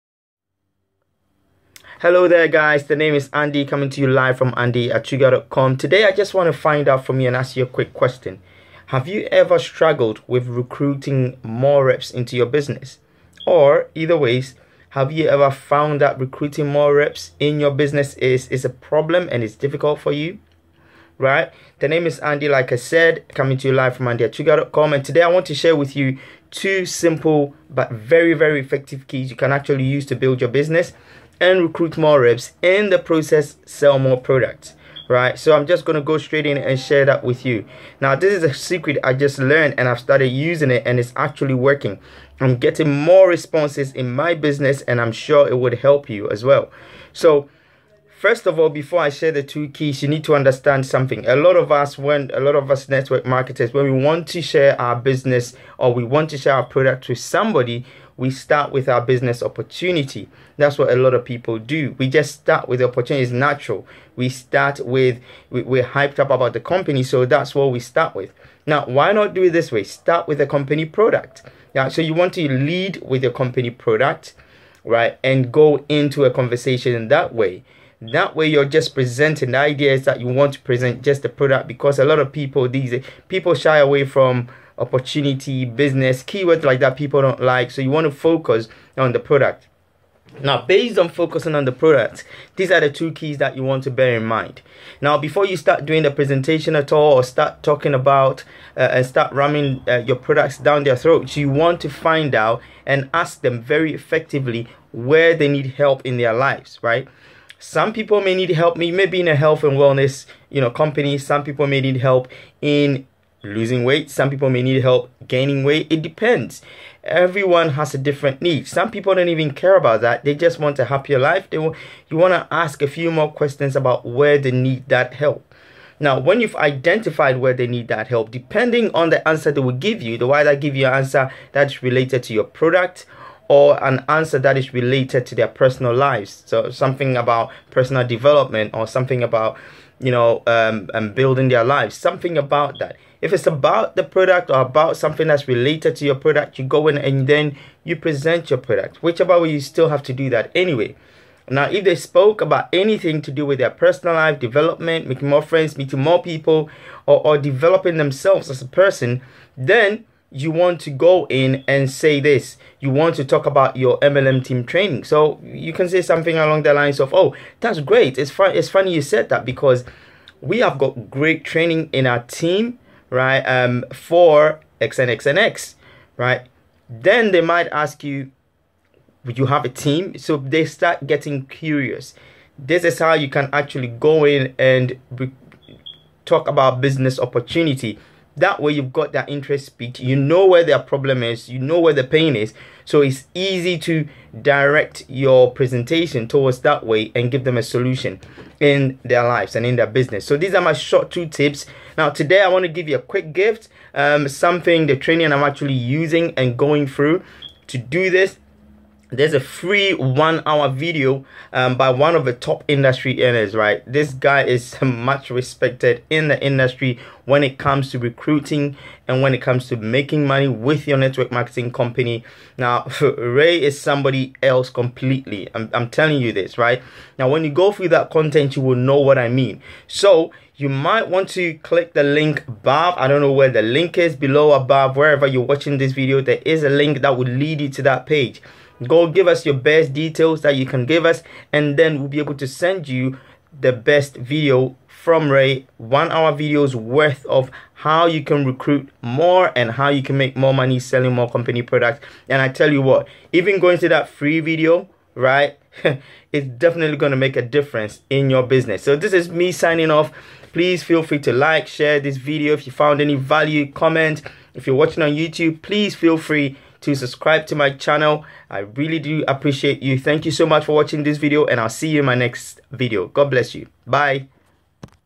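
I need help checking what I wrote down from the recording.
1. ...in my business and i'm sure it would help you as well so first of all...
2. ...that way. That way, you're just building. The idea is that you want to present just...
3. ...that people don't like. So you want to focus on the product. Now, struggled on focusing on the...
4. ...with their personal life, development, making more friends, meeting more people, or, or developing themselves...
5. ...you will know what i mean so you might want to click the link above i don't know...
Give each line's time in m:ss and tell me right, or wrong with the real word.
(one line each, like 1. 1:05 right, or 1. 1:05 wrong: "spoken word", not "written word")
1. 0:43 right
2. 1:17 wrong: "presenting", not "building"
3. 1:26 wrong: "based", not "struggled"
4. 2:33 right
5. 3:48 right.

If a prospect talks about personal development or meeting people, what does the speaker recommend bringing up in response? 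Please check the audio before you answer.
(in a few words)
MLM team training.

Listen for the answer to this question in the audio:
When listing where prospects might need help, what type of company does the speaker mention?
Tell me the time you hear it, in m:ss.
1:49.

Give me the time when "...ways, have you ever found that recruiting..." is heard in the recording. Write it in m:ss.
0:14.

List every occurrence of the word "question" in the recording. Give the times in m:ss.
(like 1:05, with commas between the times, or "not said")
0:07, 2:03.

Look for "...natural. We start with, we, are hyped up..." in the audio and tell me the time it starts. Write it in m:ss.
1:03.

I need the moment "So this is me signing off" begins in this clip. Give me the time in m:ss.
4:18.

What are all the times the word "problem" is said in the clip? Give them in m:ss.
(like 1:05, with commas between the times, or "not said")
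0:18, 3:10.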